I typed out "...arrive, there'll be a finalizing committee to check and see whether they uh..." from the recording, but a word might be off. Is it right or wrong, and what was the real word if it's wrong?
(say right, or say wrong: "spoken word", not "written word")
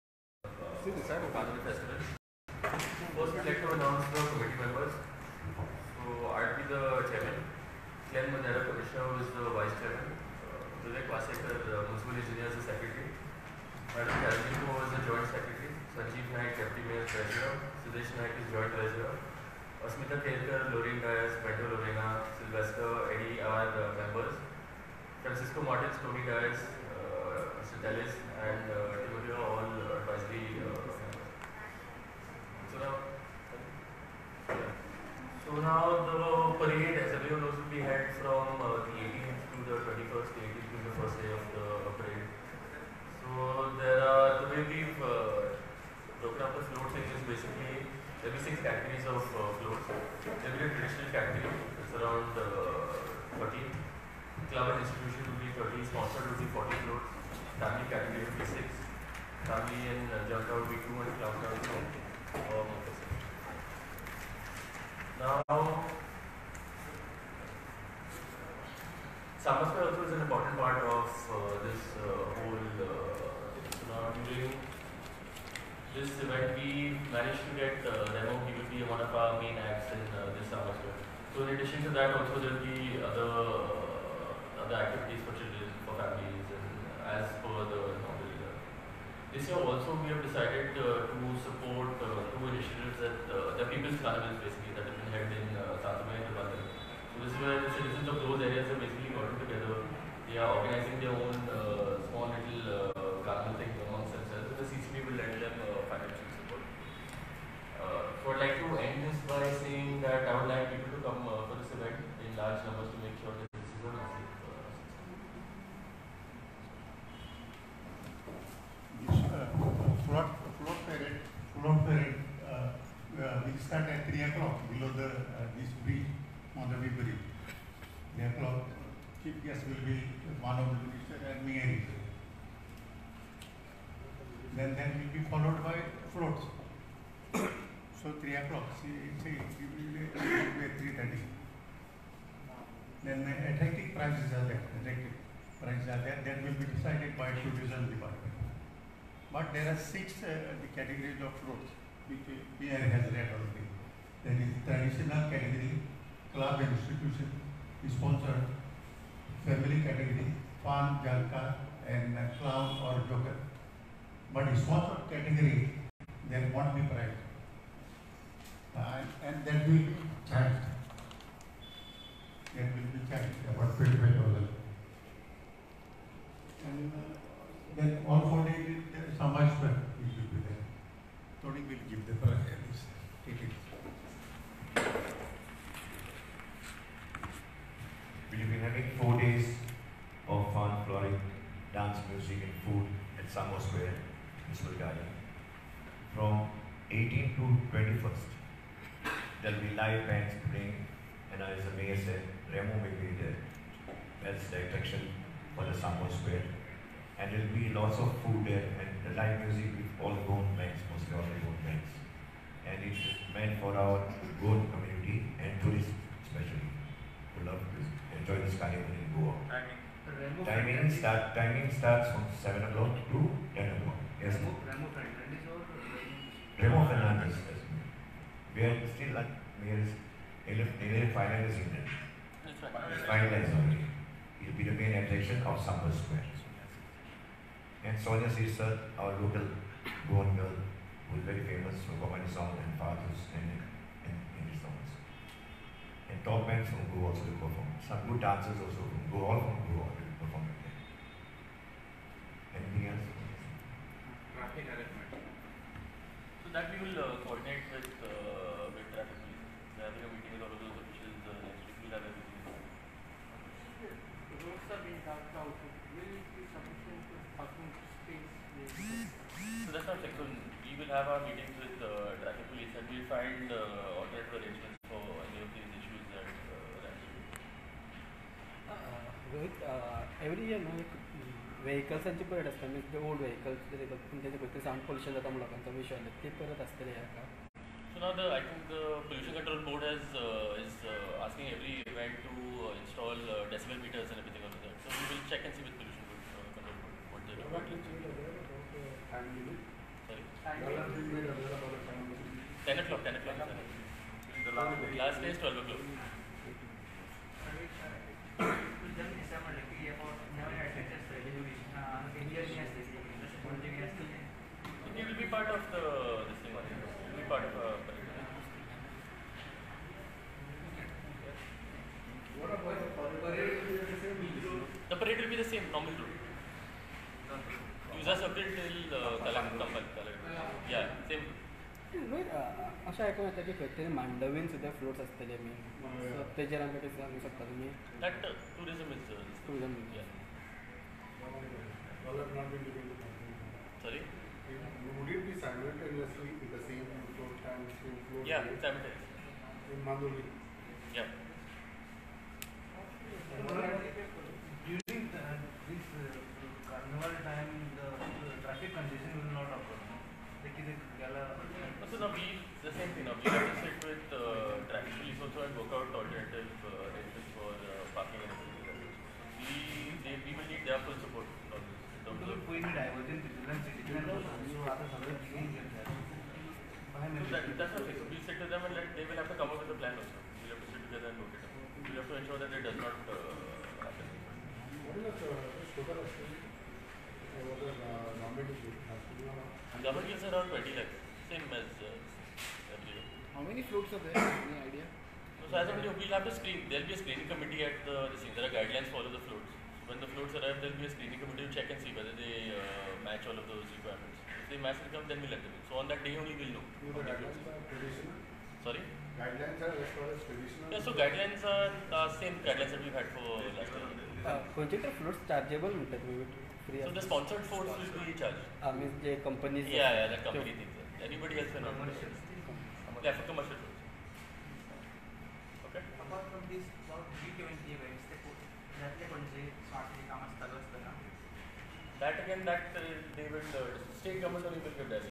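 wrong: "screening", not "finalizing".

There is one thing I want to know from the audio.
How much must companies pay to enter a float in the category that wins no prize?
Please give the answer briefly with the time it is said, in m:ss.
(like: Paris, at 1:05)
25,000, at 2:52.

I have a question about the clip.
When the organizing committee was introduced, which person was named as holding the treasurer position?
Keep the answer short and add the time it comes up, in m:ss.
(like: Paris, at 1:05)
Sanjeev Naik, at 0:15.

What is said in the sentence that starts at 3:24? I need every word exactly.
That's the attraction for the Samba Square.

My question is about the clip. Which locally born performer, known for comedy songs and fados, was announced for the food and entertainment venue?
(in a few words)
Sonia Shirsat.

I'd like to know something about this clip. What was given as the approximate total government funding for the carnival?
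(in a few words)
20 lakhs.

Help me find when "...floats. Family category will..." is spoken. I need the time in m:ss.
0:56.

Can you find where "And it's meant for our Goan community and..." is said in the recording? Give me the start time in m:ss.
3:32.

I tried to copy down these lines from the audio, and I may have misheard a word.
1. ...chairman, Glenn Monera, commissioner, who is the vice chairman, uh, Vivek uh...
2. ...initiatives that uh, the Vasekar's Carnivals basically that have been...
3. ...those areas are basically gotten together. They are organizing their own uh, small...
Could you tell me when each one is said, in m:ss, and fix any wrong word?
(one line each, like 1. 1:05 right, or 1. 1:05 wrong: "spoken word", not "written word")
1. 0:07 right
2. 1:32 wrong: "People", not "Vasekar"
3. 1:38 right.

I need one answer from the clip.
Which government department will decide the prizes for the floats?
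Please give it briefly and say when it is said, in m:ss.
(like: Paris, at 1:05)
Tourism department, at 2:27.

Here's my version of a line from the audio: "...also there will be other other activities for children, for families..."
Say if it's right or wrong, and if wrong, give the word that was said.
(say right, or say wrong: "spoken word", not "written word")
right.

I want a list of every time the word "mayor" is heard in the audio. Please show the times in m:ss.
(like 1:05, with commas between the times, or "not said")
0:16, 3:21.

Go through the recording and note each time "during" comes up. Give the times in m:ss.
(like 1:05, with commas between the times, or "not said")
1:14.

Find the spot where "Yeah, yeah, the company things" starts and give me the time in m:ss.
6:59.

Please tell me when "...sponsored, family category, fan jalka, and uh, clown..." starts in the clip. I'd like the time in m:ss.
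2:37.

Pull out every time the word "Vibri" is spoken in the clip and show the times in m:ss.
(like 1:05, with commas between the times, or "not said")
2:06.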